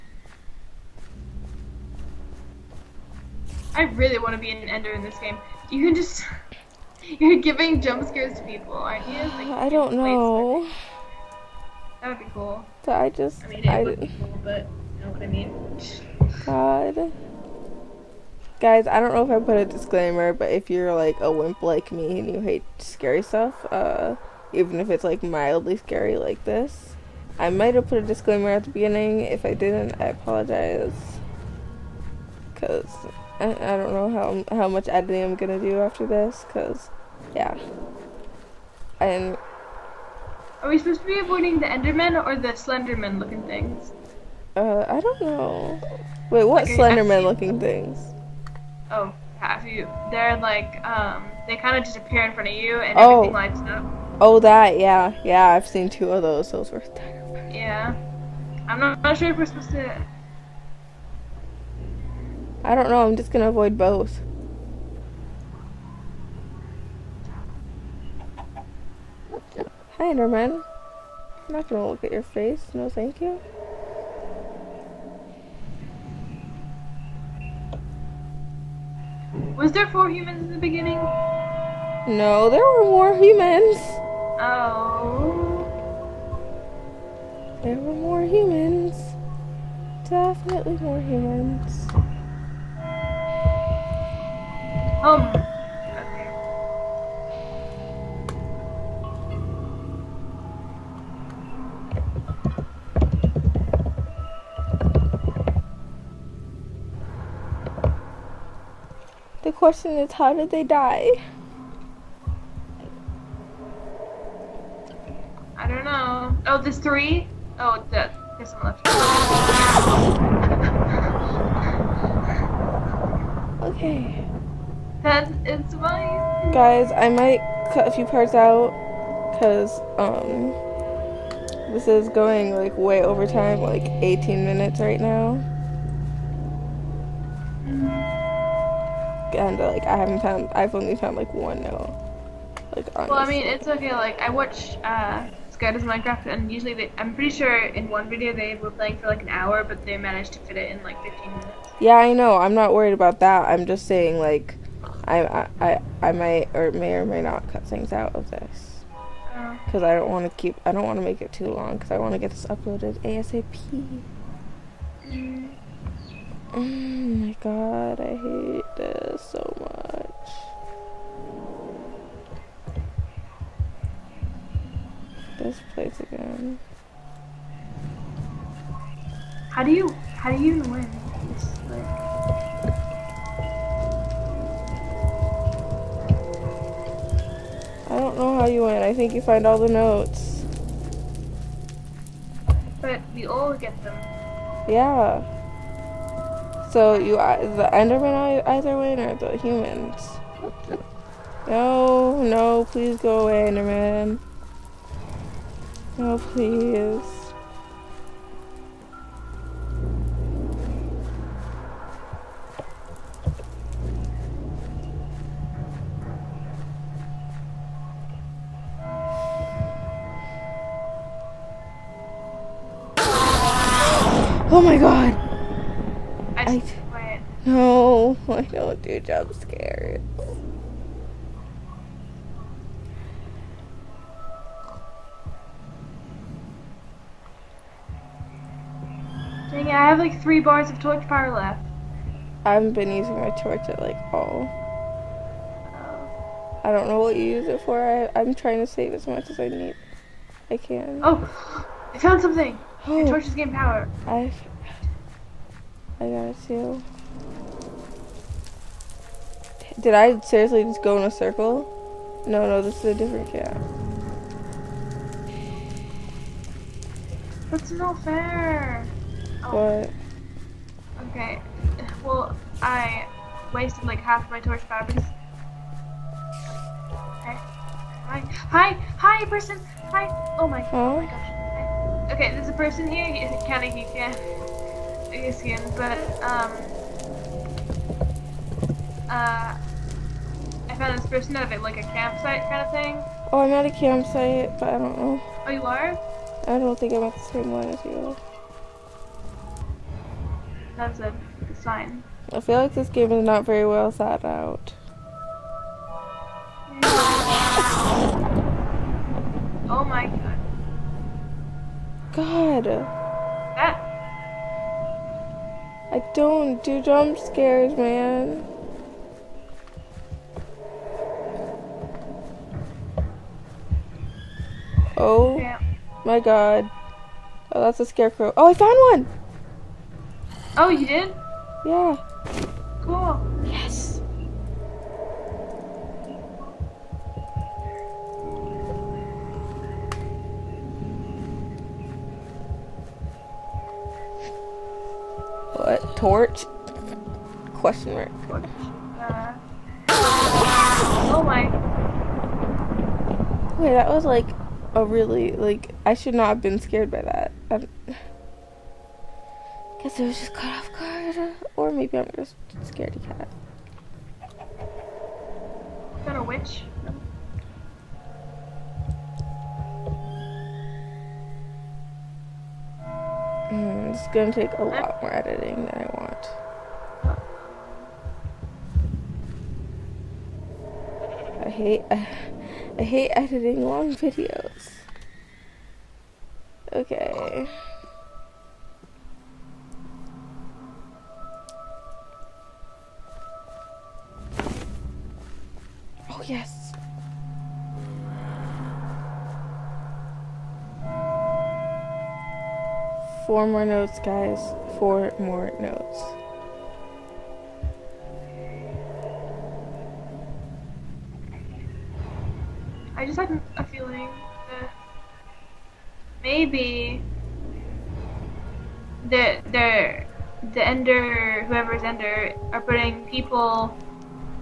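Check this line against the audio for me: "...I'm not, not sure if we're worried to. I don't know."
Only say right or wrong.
wrong.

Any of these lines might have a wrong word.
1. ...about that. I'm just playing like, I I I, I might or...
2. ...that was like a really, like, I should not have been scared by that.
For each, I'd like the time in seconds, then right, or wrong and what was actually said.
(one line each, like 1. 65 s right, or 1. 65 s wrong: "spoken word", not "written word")
1. 152 s wrong: "saying", not "playing"
2. 353 s right.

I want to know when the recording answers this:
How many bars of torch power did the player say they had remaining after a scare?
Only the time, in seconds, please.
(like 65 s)
240 s.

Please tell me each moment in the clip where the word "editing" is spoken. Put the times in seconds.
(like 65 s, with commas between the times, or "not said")
34 s, 375 s, 383 s.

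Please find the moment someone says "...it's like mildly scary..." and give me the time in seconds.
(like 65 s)
24 s.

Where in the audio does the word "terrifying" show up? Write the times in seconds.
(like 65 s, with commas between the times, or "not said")
56 s.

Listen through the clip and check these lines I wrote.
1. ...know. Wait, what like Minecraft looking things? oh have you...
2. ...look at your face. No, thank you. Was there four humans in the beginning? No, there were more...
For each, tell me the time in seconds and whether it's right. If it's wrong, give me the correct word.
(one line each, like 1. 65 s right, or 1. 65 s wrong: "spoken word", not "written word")
1. 45 s wrong: "Slenderman", not "Minecraft"
2. 71 s right.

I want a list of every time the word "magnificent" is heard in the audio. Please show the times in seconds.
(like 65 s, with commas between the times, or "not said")
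not said.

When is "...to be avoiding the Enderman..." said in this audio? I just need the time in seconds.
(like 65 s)
41 s.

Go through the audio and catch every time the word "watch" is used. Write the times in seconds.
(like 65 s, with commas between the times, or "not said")
144 s.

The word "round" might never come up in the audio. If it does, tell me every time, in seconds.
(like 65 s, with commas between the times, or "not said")
not said.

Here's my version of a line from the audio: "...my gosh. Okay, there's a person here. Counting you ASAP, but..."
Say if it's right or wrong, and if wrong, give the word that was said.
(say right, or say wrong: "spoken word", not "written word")
wrong: "Asian", not "ASAP".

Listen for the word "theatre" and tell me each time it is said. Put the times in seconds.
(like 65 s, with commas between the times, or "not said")
not said.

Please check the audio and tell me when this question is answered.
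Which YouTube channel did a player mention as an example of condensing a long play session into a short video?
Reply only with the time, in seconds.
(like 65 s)
145 s.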